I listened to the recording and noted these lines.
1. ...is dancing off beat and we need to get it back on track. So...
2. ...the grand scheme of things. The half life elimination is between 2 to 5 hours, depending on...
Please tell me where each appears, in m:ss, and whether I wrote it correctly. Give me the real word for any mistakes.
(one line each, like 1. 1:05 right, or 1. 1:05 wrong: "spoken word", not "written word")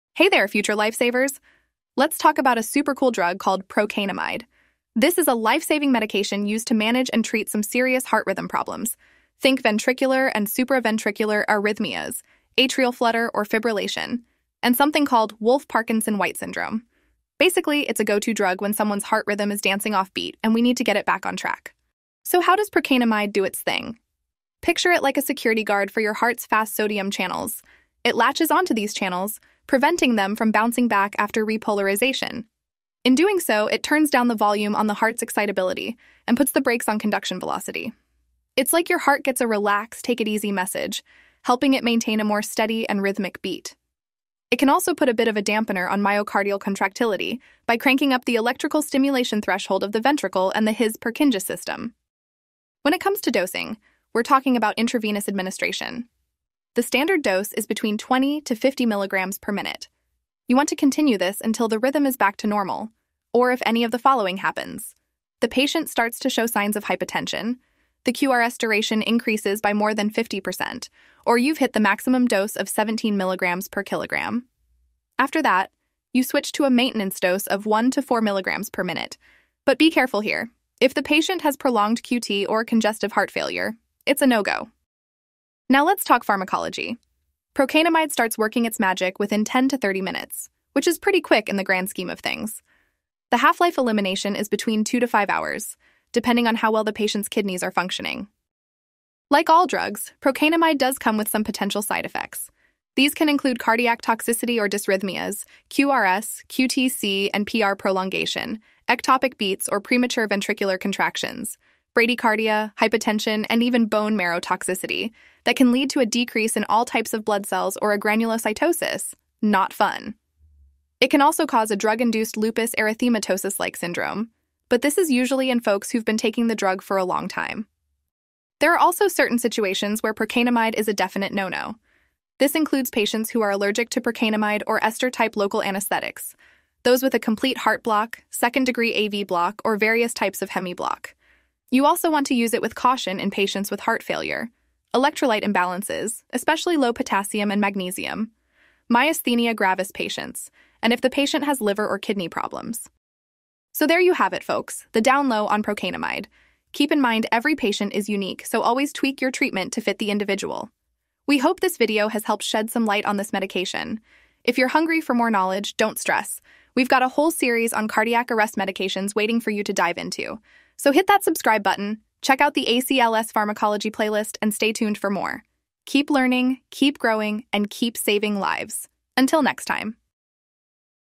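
1. 0:19 right
2. 1:31 right.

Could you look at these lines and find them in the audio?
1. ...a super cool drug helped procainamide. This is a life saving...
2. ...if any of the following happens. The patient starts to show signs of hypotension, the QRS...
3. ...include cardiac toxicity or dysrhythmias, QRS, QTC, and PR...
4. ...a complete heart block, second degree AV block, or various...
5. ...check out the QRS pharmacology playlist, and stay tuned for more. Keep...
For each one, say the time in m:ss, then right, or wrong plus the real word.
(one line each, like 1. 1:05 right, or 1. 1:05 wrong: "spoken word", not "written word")
1. 0:02 wrong: "called", not "helped"
2. 1:03 right
3. 1:43 right
4. 2:17 right
5. 2:52 wrong: "ACLS", not "QRS".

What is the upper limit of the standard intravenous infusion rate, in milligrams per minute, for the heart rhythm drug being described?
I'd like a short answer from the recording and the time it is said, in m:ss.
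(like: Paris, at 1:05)
50 milligrams per minute, at 0:58.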